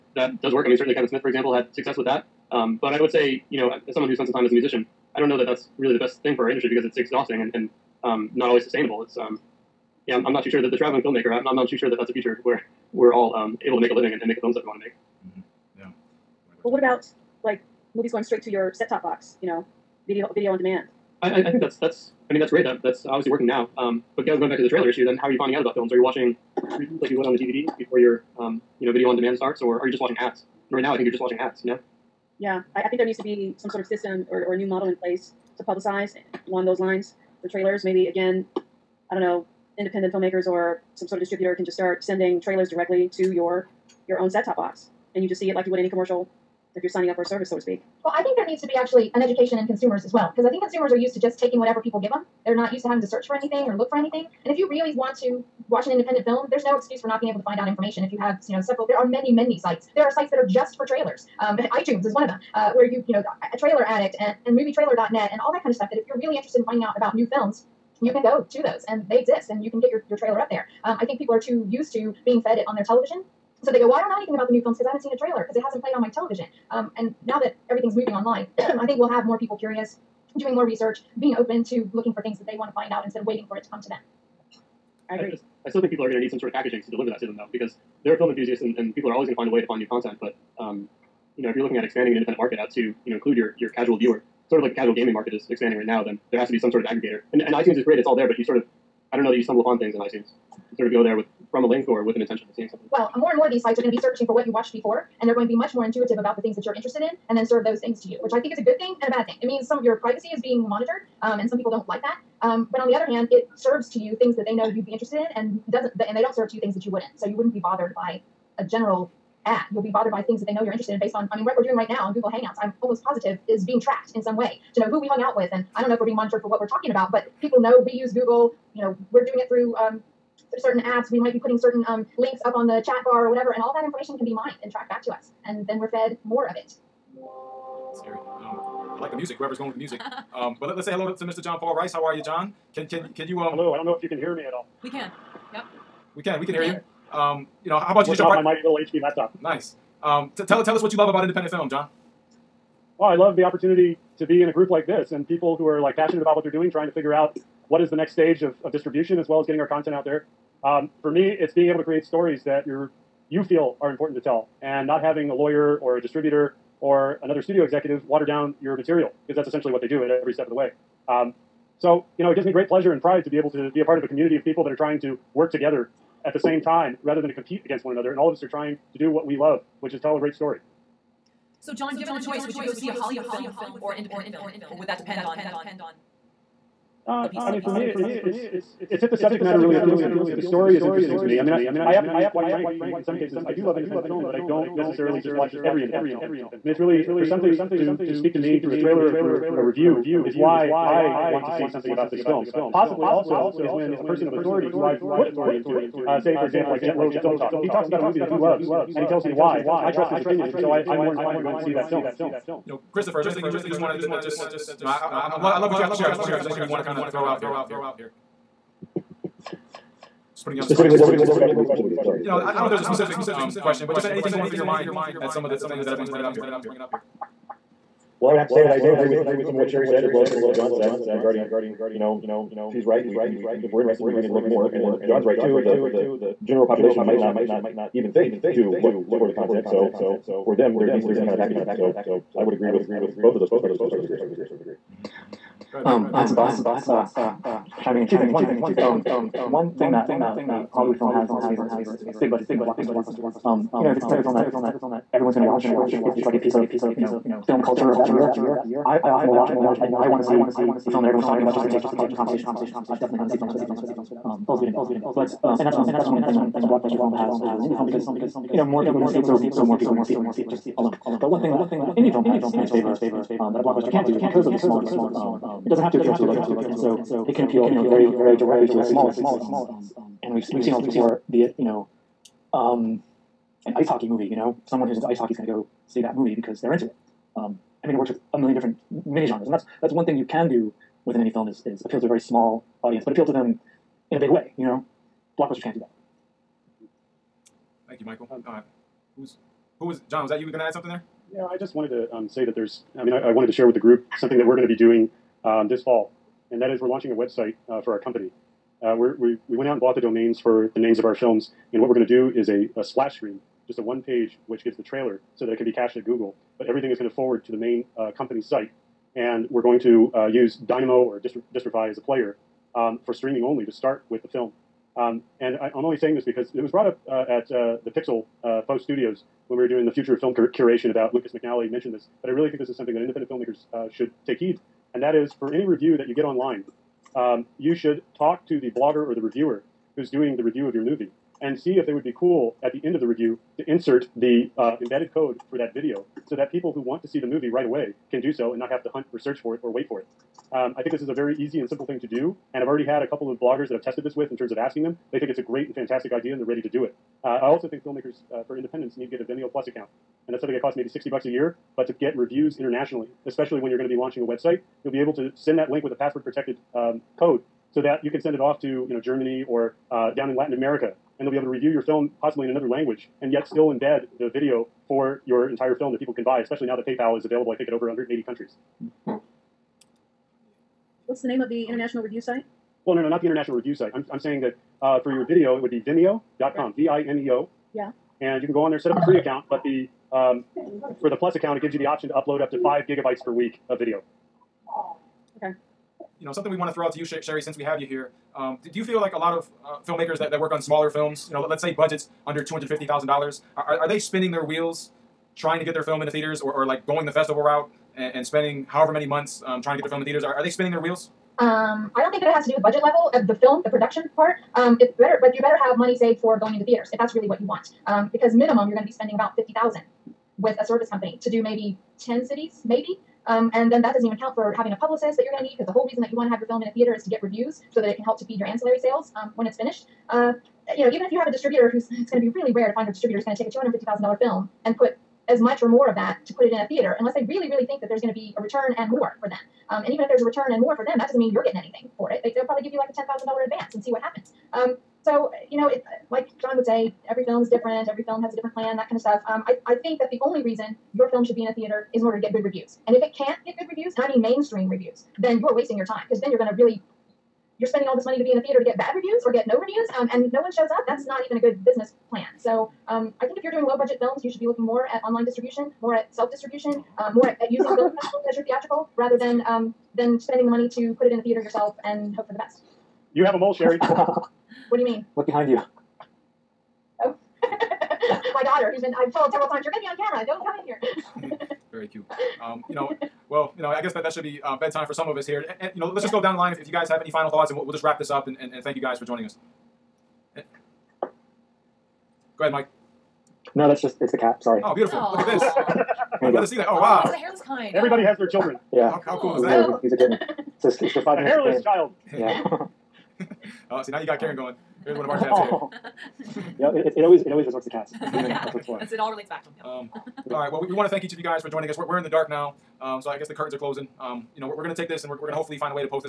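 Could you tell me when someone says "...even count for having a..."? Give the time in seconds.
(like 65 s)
424 s.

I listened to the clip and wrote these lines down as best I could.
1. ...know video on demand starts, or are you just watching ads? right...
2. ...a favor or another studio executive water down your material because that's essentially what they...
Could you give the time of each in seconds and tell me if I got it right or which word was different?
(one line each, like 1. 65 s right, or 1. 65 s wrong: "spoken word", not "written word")
1. 28 s right
2. 165 s wrong: "distributor", not "favor".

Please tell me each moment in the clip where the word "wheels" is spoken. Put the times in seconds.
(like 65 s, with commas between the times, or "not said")
404 s, 410 s.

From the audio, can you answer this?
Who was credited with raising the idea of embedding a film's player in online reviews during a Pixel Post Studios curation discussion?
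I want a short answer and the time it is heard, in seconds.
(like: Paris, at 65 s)
Lucas McNelly, at 331 s.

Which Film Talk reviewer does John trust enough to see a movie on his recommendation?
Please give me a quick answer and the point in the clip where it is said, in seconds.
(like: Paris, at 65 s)
Jet Lowe, at 206 s.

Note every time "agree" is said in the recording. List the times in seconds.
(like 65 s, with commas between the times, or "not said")
85 s, 228 s, 242 s.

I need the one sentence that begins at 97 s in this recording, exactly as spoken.
And, and iTunes is great; it's all there.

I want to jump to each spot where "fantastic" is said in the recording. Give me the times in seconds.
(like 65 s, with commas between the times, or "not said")
355 s.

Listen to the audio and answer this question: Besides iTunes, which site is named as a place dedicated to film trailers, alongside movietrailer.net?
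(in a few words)
Trailer Addict.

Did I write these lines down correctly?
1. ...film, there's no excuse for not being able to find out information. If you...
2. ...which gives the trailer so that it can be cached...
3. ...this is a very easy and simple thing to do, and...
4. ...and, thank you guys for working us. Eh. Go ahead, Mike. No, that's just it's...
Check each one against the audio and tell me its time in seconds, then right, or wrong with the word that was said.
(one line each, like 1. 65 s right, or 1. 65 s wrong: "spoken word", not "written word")
1. 56 s right
2. 314 s right
3. 350 s right
4. 488 s wrong: "joining", not "working".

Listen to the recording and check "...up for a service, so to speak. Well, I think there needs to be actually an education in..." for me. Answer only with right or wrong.
right.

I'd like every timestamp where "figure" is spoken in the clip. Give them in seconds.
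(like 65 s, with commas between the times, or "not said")
156 s.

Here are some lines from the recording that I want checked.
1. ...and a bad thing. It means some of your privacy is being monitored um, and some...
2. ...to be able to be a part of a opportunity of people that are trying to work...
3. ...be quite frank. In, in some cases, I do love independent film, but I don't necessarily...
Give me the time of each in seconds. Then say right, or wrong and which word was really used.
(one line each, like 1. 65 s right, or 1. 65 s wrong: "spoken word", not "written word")
1. 109 s right
2. 173 s wrong: "community", not "opportunity"
3. 192 s right.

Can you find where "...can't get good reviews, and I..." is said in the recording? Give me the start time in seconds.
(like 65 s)
453 s.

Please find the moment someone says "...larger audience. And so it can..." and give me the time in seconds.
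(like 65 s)
276 s.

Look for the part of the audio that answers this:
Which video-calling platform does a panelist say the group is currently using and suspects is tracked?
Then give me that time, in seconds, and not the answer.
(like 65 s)
122 s.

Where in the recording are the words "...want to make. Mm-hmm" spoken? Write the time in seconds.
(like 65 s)
14 s.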